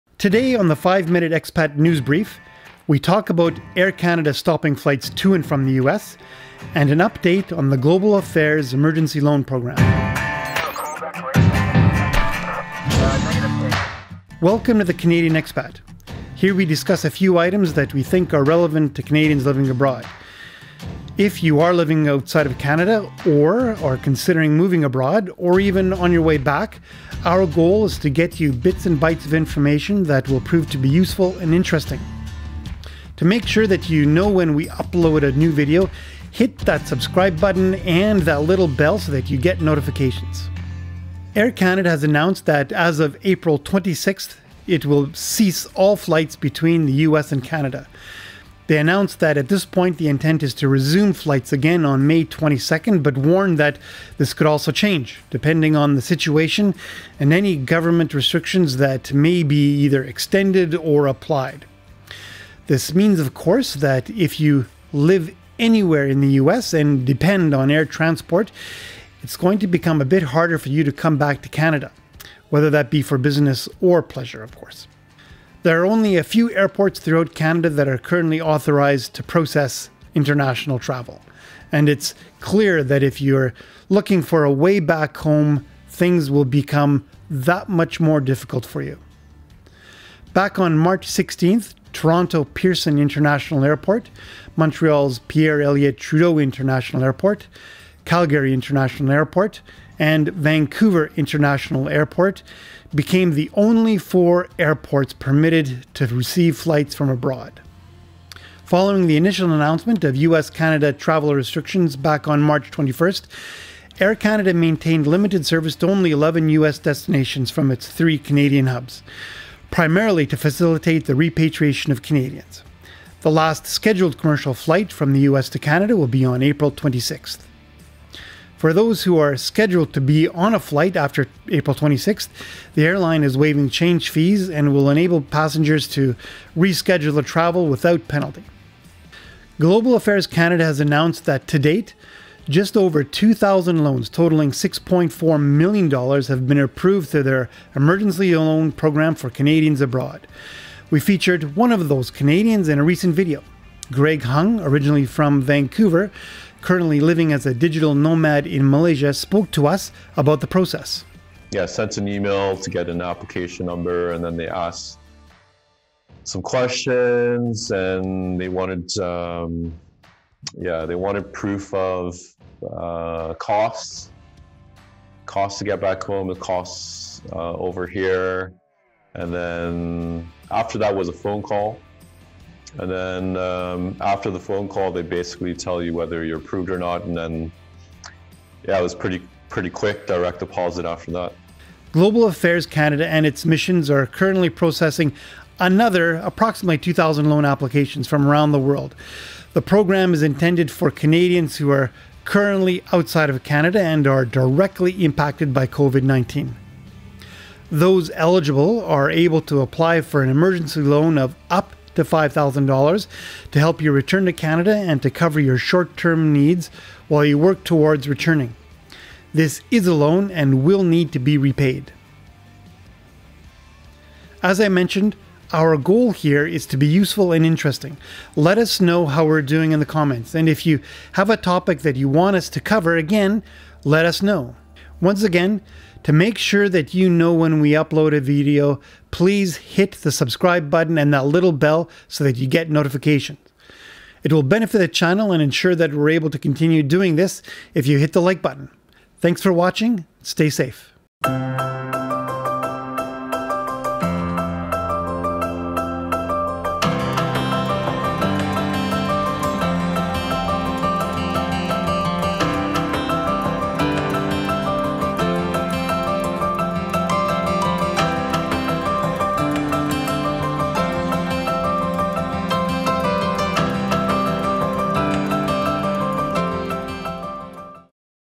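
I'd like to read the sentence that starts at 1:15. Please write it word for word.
There are only a few airports throughout Canada that are currently authorized to process international travel.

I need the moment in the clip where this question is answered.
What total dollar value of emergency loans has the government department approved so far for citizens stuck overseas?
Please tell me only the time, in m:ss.
2:24.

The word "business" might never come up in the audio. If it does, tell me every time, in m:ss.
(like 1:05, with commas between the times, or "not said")
1:13.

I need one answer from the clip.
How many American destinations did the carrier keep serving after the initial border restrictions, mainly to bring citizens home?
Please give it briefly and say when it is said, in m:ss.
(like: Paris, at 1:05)
11, at 1:56.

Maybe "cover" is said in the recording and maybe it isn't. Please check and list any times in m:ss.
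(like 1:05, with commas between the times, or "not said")
3:35, 3:52.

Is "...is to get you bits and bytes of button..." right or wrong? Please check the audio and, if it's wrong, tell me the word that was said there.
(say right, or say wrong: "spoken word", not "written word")
wrong: "information", not "button".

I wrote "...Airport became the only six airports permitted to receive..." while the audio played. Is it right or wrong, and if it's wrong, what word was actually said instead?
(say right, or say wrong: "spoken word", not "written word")
wrong: "four", not "six".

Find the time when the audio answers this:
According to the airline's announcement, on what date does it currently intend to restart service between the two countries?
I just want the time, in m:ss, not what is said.
0:52.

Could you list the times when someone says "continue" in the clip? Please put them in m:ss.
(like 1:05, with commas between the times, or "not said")
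4:06.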